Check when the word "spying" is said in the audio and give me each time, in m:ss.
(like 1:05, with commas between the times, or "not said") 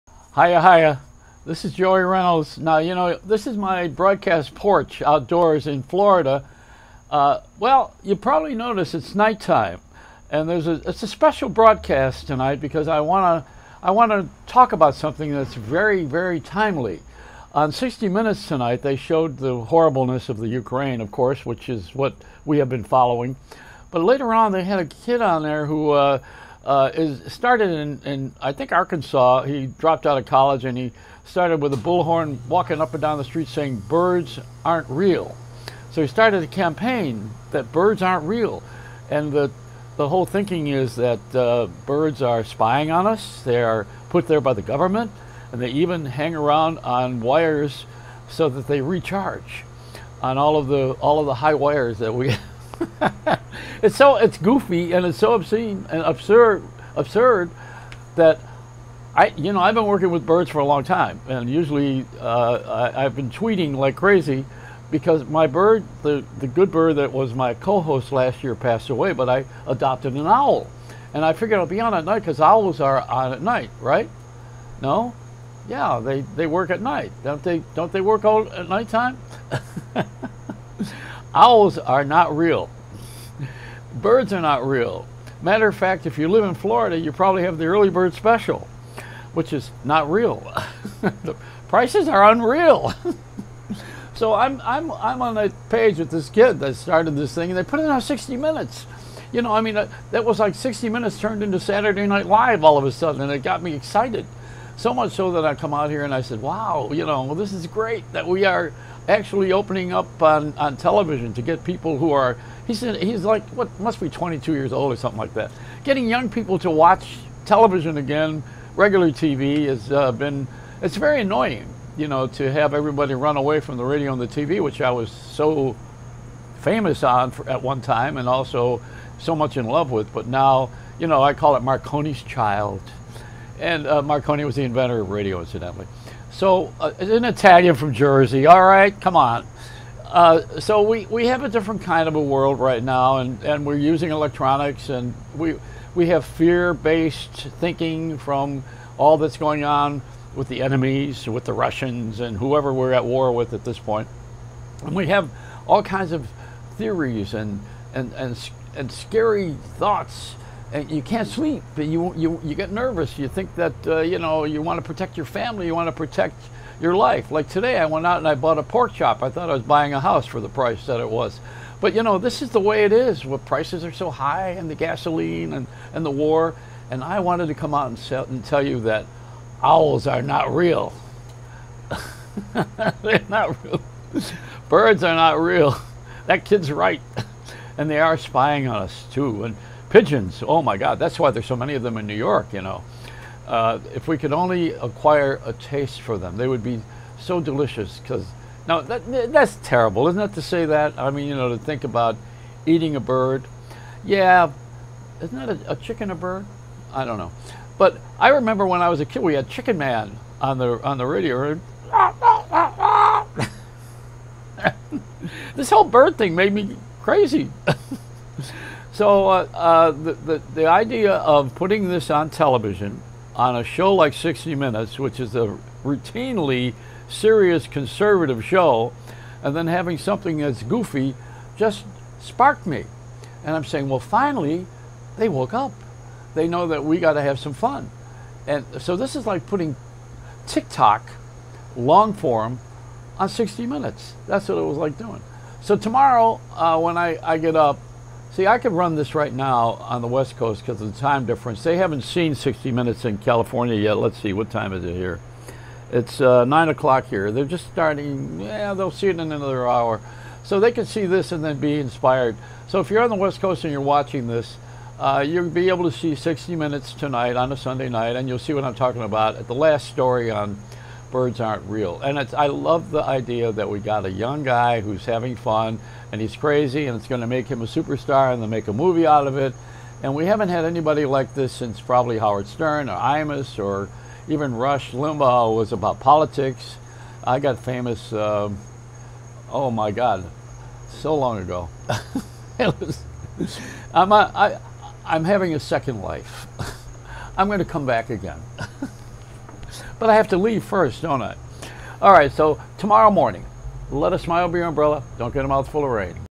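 0:42, 3:08.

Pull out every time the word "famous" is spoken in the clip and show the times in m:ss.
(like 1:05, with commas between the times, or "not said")
2:06, 4:47.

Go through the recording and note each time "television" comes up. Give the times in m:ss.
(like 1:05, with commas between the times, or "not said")
1:50, 1:57, 3:42.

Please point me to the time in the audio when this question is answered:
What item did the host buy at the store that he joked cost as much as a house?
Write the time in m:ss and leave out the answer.
2:48.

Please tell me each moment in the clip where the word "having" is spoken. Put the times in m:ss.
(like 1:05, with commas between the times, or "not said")
3:49, 4:35, 4:55.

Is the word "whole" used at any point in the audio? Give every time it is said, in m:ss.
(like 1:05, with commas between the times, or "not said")
0:40, 3:35.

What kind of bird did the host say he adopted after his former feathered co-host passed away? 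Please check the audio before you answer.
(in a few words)
An owl.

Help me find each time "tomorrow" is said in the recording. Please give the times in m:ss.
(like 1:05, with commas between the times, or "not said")
4:05, 5:02.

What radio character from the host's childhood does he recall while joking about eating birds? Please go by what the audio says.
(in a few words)
Chicken Man.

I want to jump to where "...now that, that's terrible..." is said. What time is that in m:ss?
3:18.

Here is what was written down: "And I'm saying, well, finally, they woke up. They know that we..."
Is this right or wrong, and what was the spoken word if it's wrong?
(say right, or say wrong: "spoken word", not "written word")
right.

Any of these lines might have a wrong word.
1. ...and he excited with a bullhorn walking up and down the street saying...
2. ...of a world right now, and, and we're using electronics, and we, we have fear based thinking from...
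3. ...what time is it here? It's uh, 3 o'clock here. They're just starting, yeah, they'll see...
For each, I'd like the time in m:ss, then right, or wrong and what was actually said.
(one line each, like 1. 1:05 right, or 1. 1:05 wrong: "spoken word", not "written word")
1. 0:30 wrong: "started", not "excited"
2. 2:22 right
3. 4:14 wrong: "9", not "3".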